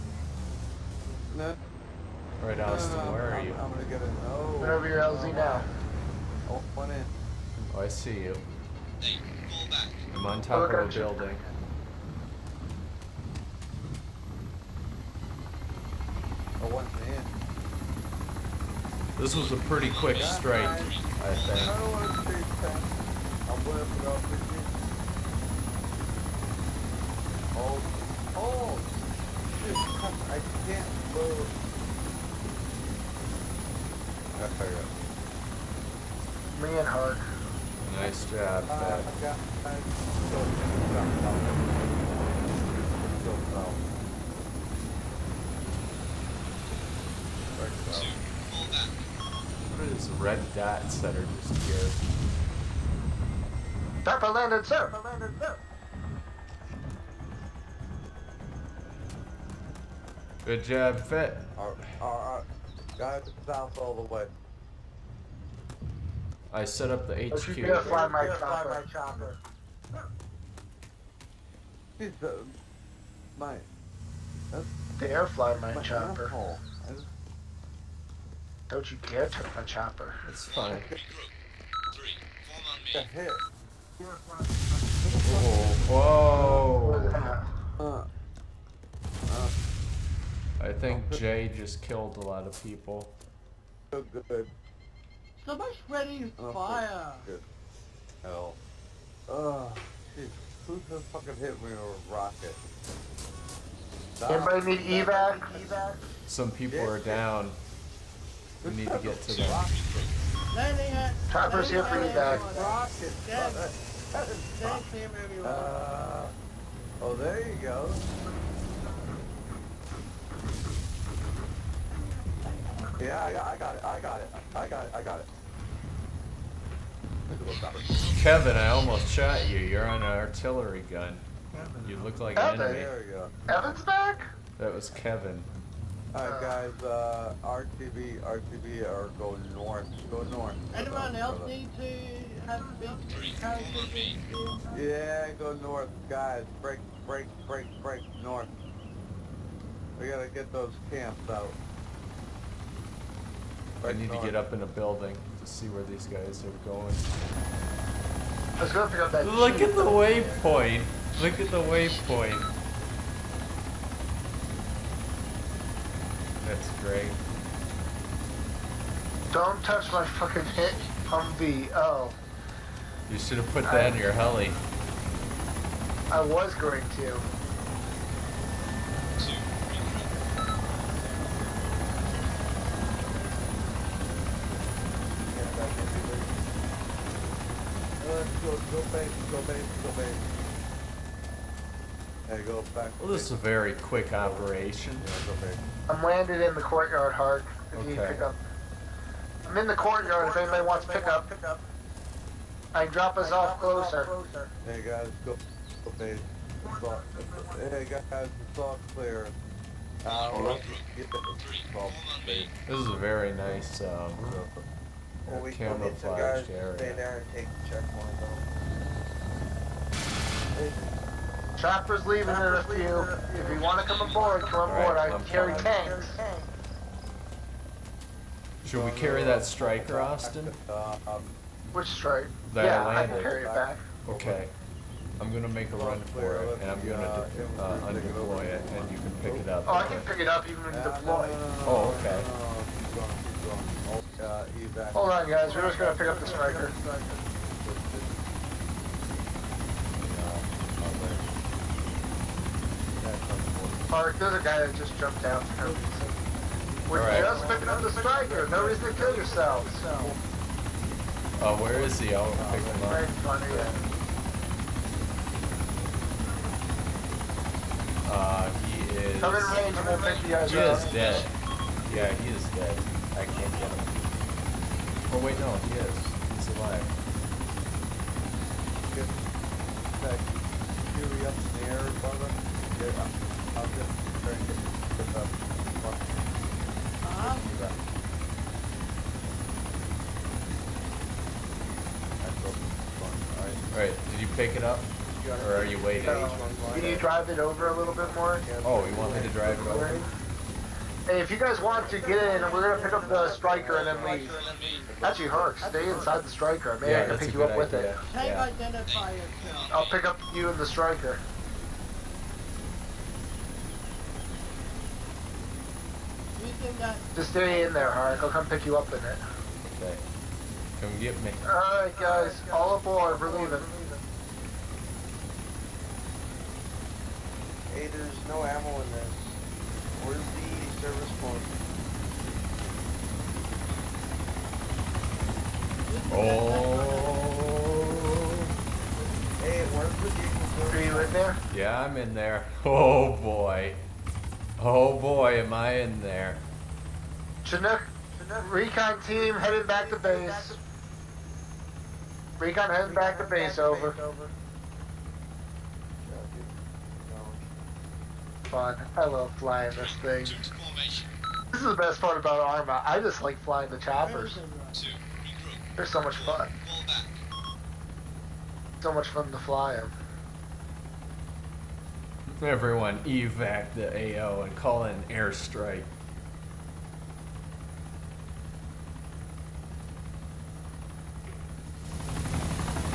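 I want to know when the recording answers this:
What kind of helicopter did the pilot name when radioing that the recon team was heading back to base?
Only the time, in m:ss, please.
5:47.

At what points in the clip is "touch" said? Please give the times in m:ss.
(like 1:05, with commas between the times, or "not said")
1:19, 2:49.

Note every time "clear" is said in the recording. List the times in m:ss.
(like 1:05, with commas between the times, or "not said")
3:28.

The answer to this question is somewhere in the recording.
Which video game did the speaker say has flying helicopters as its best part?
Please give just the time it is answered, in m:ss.
6:00.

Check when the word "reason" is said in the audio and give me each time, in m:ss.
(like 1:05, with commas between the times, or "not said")
4:18.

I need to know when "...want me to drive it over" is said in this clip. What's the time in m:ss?
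4:58.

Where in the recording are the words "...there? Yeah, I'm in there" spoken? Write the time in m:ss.
5:41.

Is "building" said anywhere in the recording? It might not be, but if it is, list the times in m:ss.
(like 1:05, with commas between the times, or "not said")
0:10, 2:34.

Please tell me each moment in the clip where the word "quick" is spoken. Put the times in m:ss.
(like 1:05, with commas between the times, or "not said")
0:19, 3:13.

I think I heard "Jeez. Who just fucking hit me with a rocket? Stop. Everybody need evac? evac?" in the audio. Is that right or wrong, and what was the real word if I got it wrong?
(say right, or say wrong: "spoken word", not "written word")
right.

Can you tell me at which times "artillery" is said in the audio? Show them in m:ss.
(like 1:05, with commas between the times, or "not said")
2:10.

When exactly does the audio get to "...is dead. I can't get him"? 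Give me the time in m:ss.
4:32.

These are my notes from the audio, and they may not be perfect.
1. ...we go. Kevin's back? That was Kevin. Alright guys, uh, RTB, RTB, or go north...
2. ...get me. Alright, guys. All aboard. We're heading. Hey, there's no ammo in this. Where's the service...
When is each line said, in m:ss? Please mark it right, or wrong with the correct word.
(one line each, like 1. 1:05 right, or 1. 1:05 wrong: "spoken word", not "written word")
1. 2:13 right
2. 5:20 wrong: "leaving", not "heading".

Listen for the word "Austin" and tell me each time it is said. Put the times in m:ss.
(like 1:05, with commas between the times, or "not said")
0:02, 3:49.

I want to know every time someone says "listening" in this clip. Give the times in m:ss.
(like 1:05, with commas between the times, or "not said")
not said.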